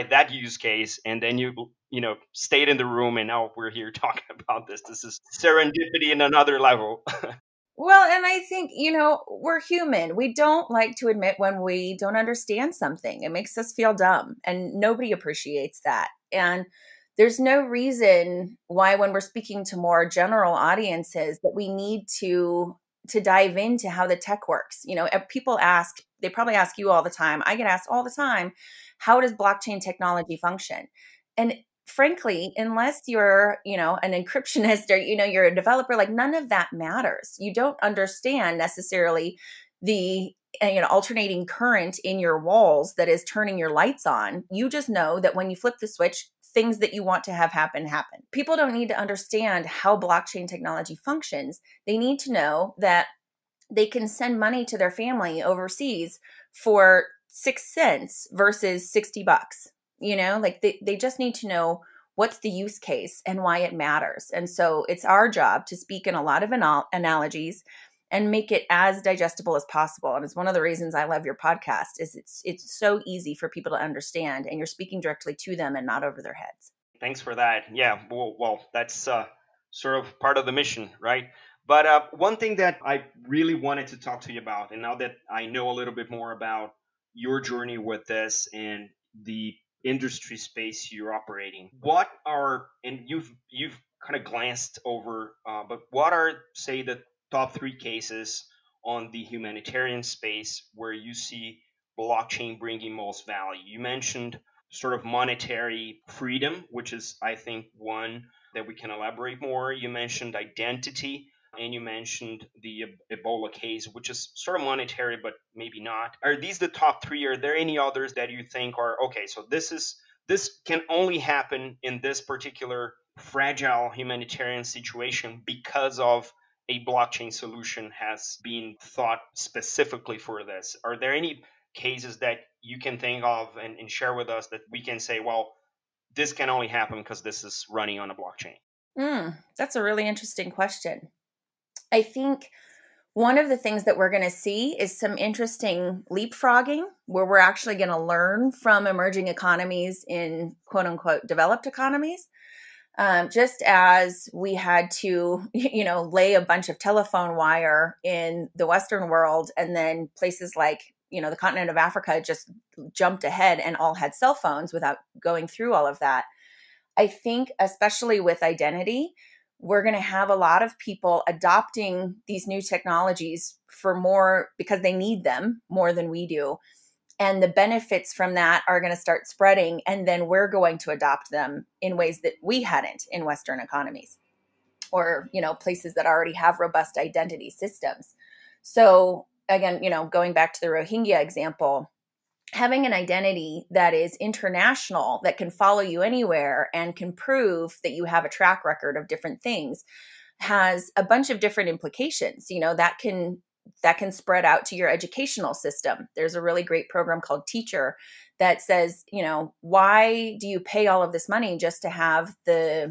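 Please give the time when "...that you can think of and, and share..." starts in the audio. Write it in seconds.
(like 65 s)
132 s.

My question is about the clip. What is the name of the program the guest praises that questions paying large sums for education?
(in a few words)
Teachur.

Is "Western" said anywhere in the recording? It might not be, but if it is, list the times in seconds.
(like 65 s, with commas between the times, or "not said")
158 s, 183 s.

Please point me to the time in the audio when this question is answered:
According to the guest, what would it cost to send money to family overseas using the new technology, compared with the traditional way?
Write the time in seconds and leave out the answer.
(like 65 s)
57 s.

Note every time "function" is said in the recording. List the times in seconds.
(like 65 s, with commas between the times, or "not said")
30 s, 51 s.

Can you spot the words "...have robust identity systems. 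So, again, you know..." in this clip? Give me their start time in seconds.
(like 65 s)
186 s.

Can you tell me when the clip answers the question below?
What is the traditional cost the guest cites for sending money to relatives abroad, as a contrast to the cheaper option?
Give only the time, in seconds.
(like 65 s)
58 s.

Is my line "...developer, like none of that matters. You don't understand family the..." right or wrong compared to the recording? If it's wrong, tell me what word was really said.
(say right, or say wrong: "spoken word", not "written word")
wrong: "necessarily", not "family".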